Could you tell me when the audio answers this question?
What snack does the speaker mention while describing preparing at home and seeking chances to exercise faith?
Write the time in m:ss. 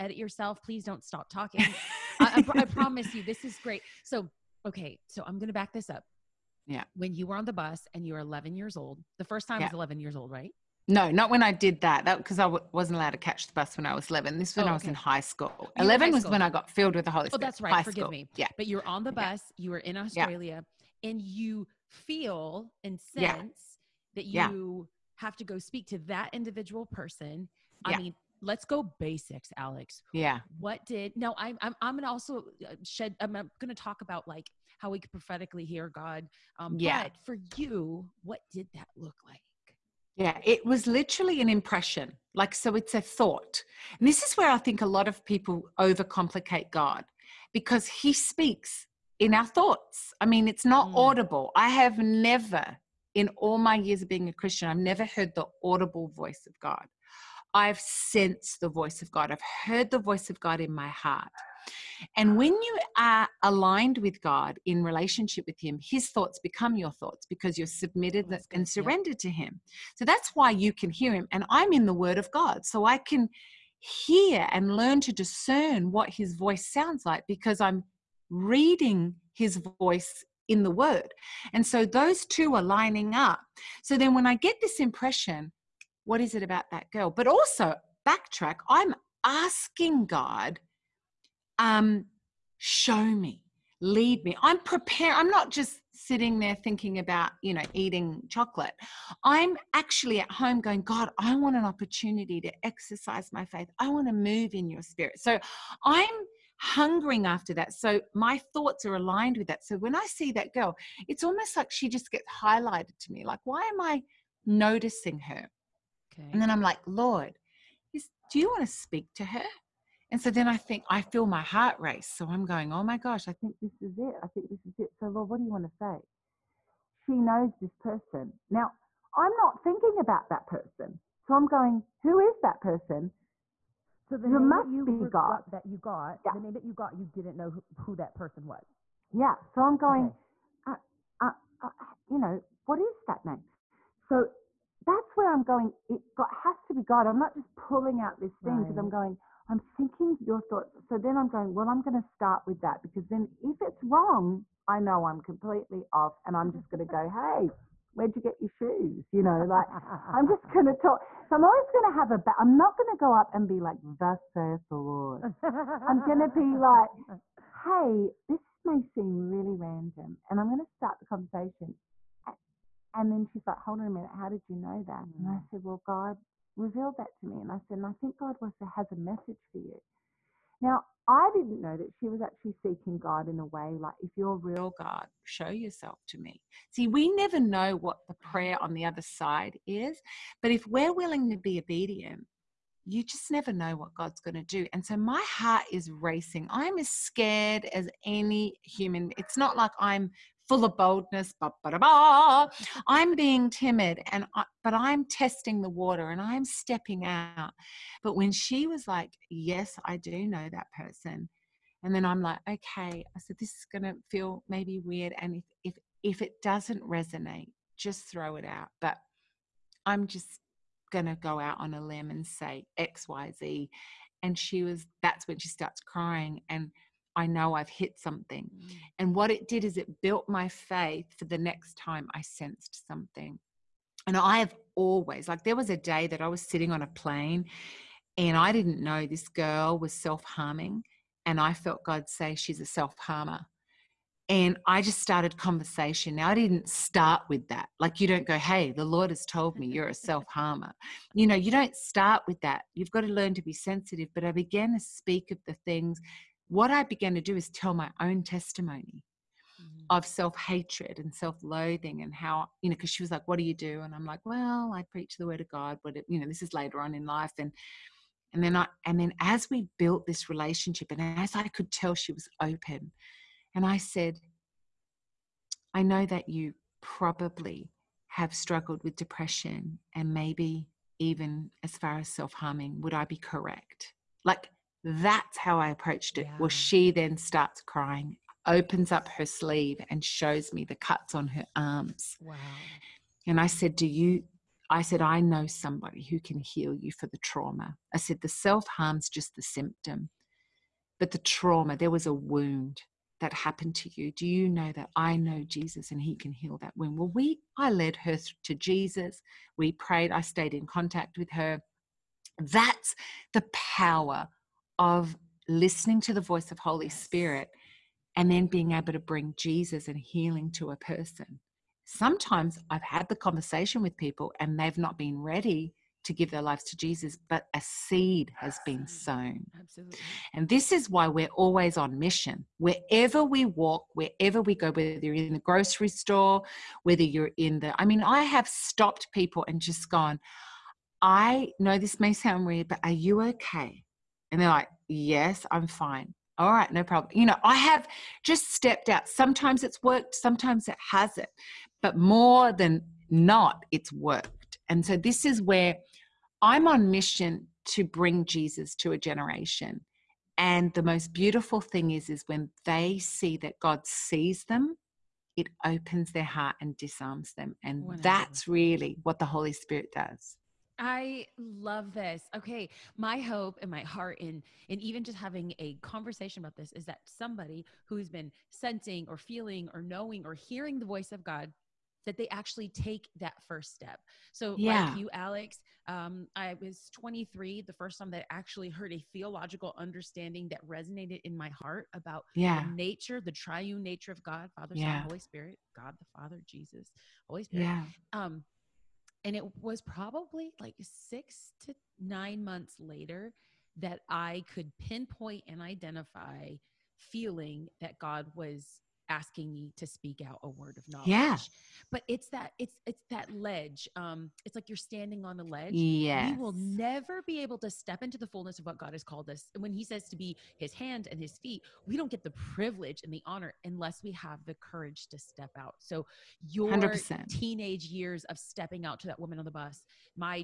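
1:38.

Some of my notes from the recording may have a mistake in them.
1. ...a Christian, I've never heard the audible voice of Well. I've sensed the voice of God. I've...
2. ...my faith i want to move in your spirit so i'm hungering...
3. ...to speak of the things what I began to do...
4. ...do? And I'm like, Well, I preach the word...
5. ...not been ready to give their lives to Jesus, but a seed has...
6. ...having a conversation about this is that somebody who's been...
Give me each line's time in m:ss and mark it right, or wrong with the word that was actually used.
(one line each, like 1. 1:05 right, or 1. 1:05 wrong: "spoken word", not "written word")
1. 0:54 wrong: "God", not "Well"
2. 1:43 right
3. 4:14 right
4. 4:23 right
5. 5:24 right
6. 6:15 right.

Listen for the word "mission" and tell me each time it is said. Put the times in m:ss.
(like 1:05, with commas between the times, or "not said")
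5:31, 5:56.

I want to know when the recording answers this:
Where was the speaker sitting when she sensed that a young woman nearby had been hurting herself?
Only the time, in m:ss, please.
3:56.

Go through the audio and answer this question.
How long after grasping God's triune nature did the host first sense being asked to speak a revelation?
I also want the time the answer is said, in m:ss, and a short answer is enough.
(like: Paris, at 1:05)
6 to 9 months, at 6:40.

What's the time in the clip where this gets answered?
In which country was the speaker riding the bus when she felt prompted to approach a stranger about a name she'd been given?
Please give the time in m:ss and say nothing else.
0:19.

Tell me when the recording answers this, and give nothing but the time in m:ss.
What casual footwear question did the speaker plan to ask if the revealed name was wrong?
2:37.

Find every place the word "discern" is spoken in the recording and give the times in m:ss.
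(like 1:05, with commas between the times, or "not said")
1:15.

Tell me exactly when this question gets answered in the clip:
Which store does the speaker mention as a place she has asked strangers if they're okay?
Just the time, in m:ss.
5:35.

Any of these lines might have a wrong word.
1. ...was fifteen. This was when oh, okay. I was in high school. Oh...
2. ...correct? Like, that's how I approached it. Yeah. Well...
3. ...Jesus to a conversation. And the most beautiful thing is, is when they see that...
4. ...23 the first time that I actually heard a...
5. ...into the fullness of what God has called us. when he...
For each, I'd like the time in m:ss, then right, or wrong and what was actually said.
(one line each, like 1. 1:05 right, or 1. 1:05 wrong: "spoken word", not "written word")
1. 0:13 wrong: "eleven", not "fifteen"
2. 4:43 right
3. 5:58 wrong: "generation", not "conversation"
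4. 6:26 right
5. 6:58 right.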